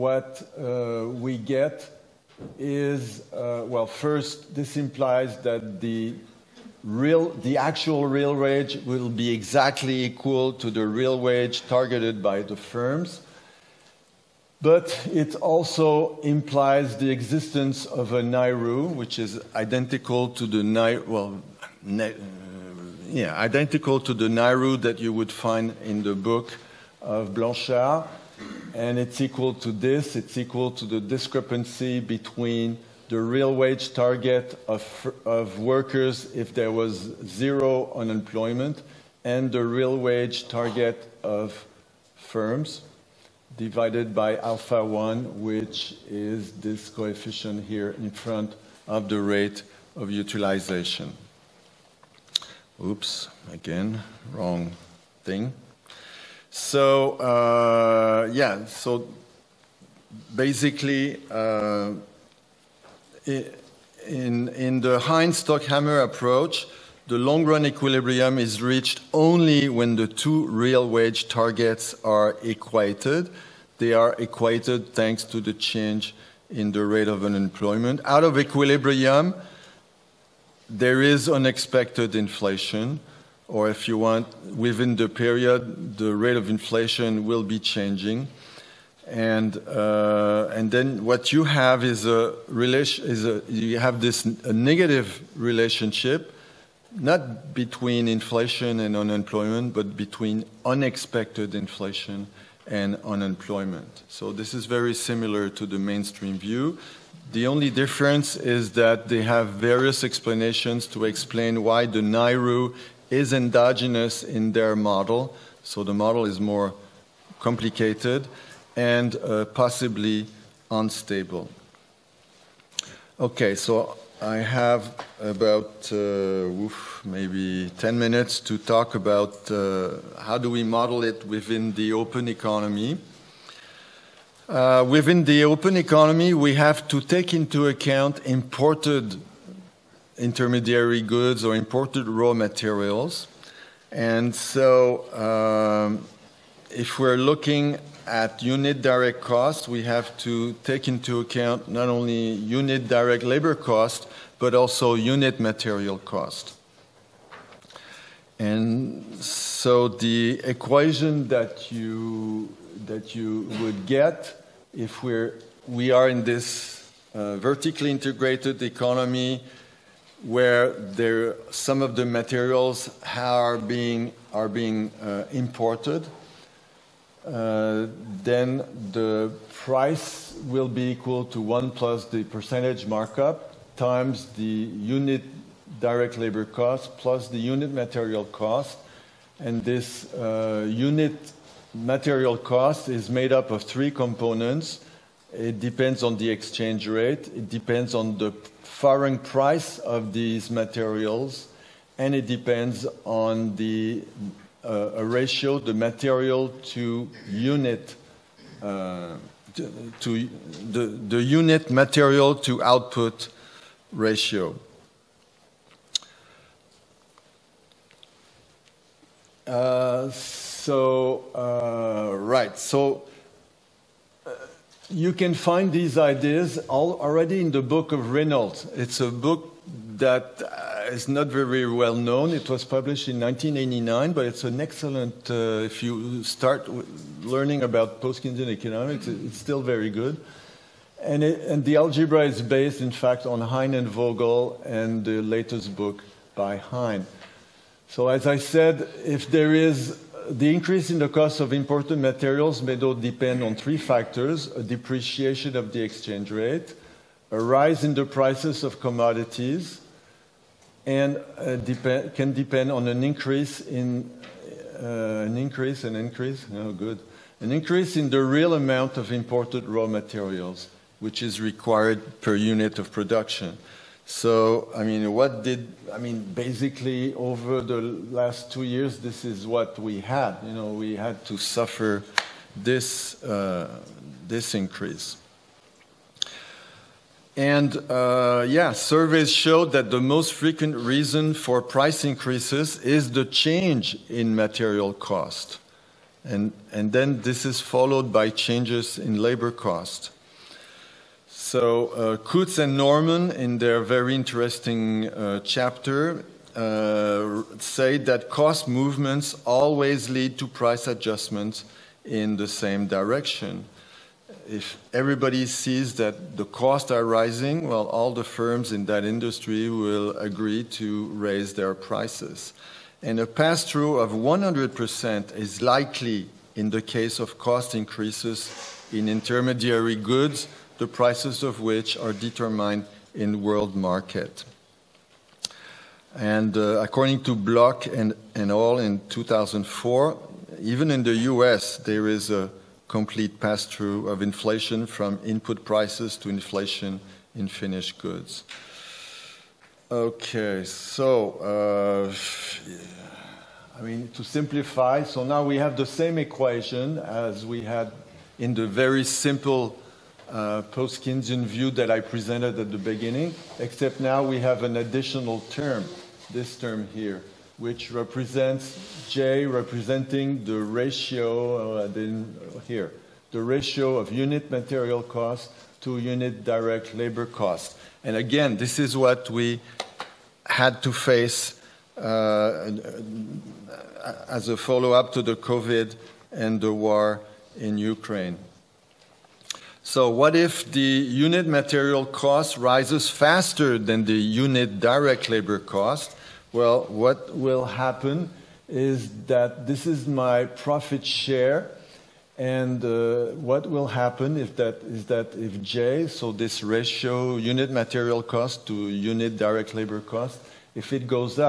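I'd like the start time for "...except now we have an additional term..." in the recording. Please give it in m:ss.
6:03.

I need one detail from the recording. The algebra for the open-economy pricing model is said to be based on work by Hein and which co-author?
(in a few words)
Vogel.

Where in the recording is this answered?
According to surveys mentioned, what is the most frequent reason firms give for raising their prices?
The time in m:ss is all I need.
4:53.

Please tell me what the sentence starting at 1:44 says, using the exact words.
So this is very similar to the mainstream view.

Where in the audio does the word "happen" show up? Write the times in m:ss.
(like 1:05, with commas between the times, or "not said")
6:37, 6:43.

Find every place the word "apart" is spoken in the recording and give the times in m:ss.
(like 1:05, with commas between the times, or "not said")
not said.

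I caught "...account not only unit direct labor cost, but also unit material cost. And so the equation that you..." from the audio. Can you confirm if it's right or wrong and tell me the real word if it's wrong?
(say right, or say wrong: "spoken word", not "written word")
right.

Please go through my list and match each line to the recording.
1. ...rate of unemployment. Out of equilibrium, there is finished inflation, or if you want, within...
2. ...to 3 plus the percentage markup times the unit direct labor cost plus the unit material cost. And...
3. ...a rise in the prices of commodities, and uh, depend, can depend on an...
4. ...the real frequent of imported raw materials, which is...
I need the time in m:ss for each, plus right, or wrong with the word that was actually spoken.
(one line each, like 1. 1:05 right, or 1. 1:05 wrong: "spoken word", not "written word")
1. 1:16 wrong: "unexpected", not "finished"
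2. 3:01 wrong: "1", not "3"
3. 4:17 right
4. 4:28 wrong: "amount", not "frequent".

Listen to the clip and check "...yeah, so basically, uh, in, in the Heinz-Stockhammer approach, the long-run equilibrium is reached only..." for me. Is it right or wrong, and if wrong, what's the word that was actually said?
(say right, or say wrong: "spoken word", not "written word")
right.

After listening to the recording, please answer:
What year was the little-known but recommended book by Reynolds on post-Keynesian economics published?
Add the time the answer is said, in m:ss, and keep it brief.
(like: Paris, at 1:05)
1989, at 3:53.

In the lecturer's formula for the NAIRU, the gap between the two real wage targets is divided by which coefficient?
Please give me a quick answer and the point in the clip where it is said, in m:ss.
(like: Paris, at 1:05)
alpha 1, at 0:44.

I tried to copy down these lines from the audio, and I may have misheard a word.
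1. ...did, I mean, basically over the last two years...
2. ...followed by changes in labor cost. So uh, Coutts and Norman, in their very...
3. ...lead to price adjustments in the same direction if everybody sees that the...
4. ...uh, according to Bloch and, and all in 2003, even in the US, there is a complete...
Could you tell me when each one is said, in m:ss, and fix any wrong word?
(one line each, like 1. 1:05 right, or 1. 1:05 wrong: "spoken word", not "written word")
1. 4:35 right
2. 4:57 right
3. 5:10 right
4. 5:36 wrong: "2004", not "2003".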